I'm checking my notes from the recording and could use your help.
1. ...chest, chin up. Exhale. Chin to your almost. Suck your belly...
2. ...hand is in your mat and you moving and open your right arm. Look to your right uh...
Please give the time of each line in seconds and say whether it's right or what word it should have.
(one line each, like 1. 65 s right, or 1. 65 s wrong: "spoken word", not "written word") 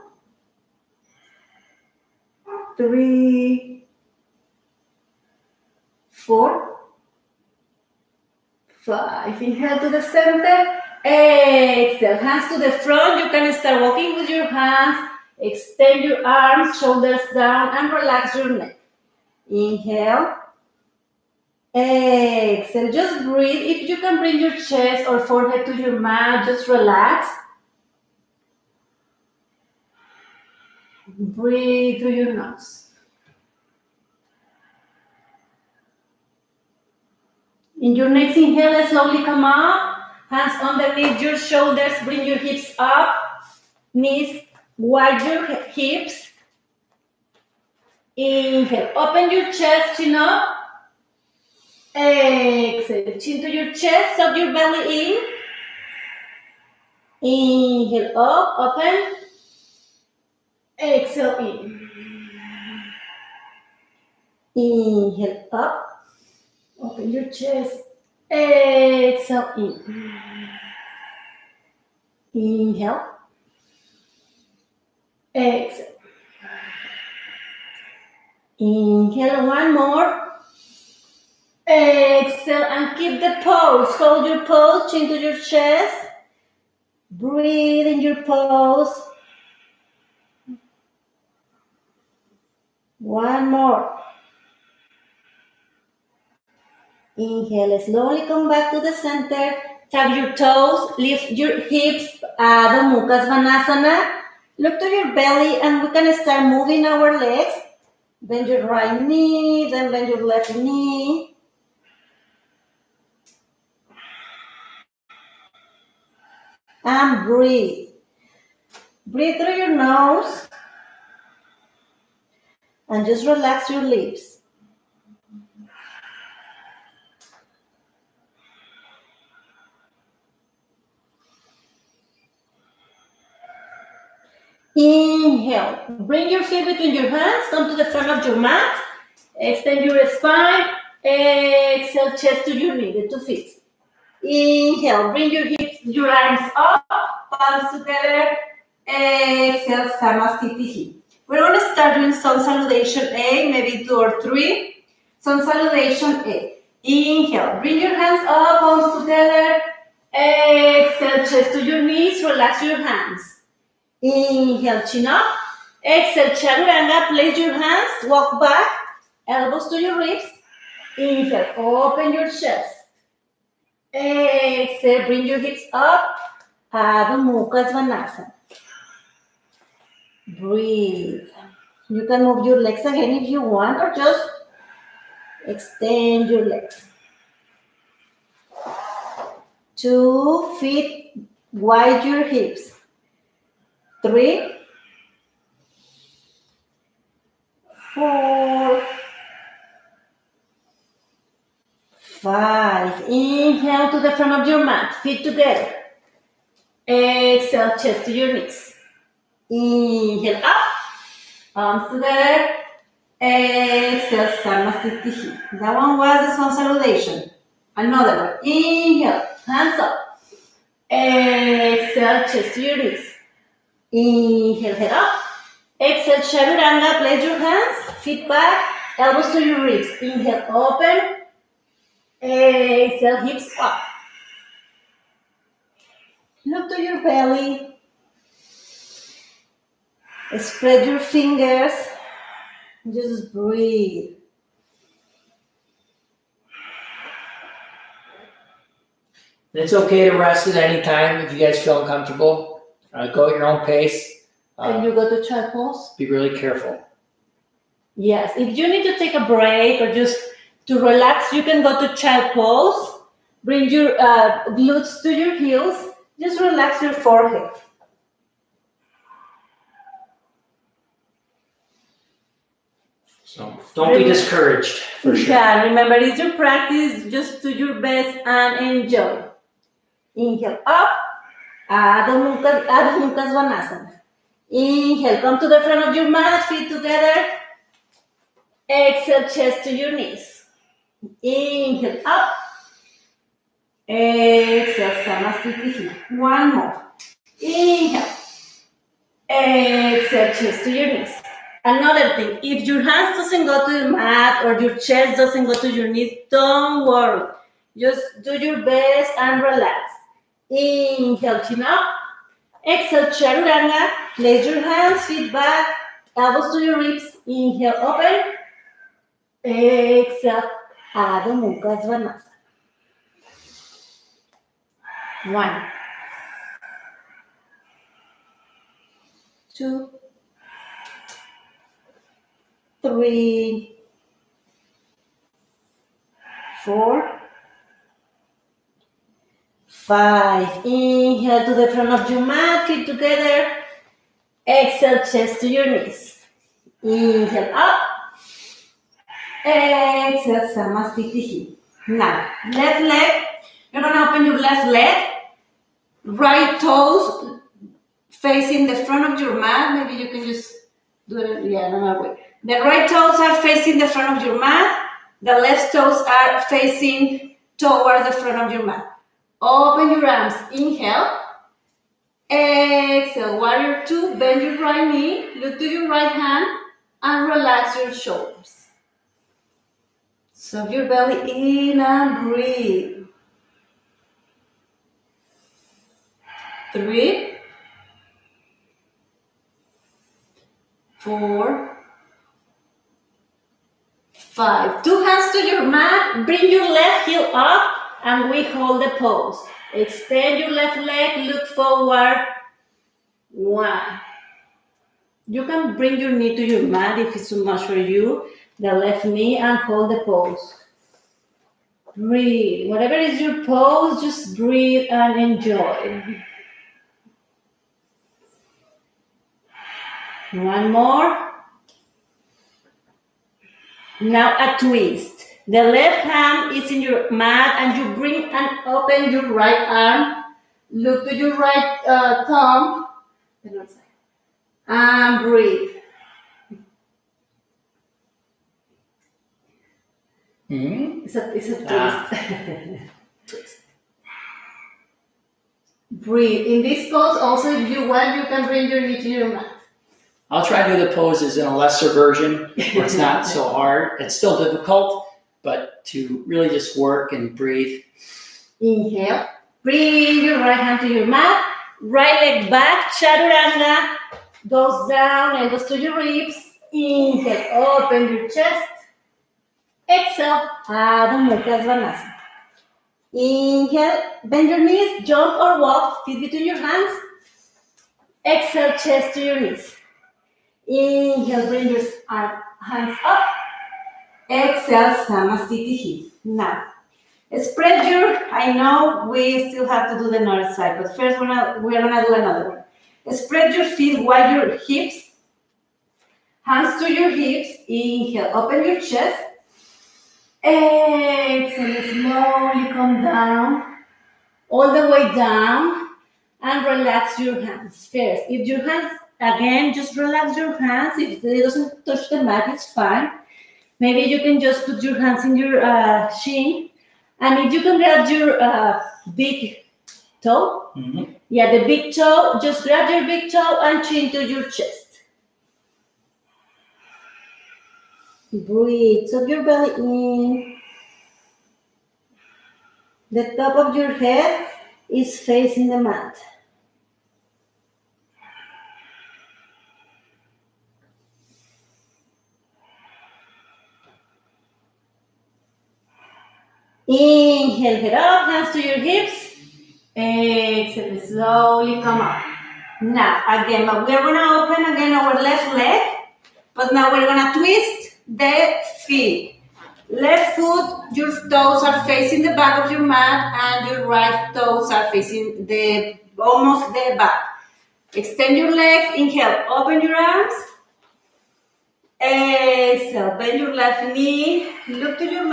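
1. 49 s wrong: "chest", not "almost"
2. 426 s wrong: "bring", not "moving".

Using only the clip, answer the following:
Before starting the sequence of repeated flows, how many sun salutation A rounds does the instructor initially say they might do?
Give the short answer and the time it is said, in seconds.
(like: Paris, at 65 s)
2 or 3, at 153 s.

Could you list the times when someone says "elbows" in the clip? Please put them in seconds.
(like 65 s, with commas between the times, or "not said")
169 s, 228 s, 316 s.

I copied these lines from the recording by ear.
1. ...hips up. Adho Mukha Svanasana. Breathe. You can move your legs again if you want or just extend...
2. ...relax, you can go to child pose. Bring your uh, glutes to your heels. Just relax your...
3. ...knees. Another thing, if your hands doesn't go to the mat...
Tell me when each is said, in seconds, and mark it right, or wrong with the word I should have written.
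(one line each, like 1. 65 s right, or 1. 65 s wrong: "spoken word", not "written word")
1. 175 s right
2. 260 s right
3. 300 s right.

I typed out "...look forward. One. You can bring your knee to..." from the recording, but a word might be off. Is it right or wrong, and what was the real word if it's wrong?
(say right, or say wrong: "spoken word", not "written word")
right.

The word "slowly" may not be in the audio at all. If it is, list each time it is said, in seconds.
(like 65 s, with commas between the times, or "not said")
38 s, 97 s, 501 s, 551 s.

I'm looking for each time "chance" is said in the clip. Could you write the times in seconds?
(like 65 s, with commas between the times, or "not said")
not said.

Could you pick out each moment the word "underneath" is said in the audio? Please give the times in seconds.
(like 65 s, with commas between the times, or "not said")
40 s.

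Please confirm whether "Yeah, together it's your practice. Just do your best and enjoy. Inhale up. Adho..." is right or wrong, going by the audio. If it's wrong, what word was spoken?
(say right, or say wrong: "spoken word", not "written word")
wrong: "remember", not "together".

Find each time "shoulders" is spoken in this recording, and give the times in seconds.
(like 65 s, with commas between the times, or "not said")
16 s, 41 s, 377 s.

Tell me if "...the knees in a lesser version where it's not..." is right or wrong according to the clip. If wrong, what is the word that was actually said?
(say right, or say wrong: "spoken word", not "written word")
wrong: "poses", not "knees".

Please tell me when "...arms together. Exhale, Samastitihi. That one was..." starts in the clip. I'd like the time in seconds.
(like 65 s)
211 s.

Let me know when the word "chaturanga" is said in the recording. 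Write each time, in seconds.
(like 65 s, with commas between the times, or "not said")
166 s, 226 s, 313 s, 462 s.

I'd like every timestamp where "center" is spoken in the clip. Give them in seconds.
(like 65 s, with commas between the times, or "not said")
10 s, 98 s.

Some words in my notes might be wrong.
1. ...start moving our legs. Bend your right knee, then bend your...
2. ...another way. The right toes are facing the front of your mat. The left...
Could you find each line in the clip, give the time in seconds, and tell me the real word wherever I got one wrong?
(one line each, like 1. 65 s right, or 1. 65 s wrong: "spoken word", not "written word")
1. 106 s right
2. 361 s right.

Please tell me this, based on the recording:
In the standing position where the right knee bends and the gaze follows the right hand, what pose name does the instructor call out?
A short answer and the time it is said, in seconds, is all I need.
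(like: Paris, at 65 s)
Warrior two, at 373 s.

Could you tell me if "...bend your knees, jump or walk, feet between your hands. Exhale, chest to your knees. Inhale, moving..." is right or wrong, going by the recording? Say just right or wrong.
wrong.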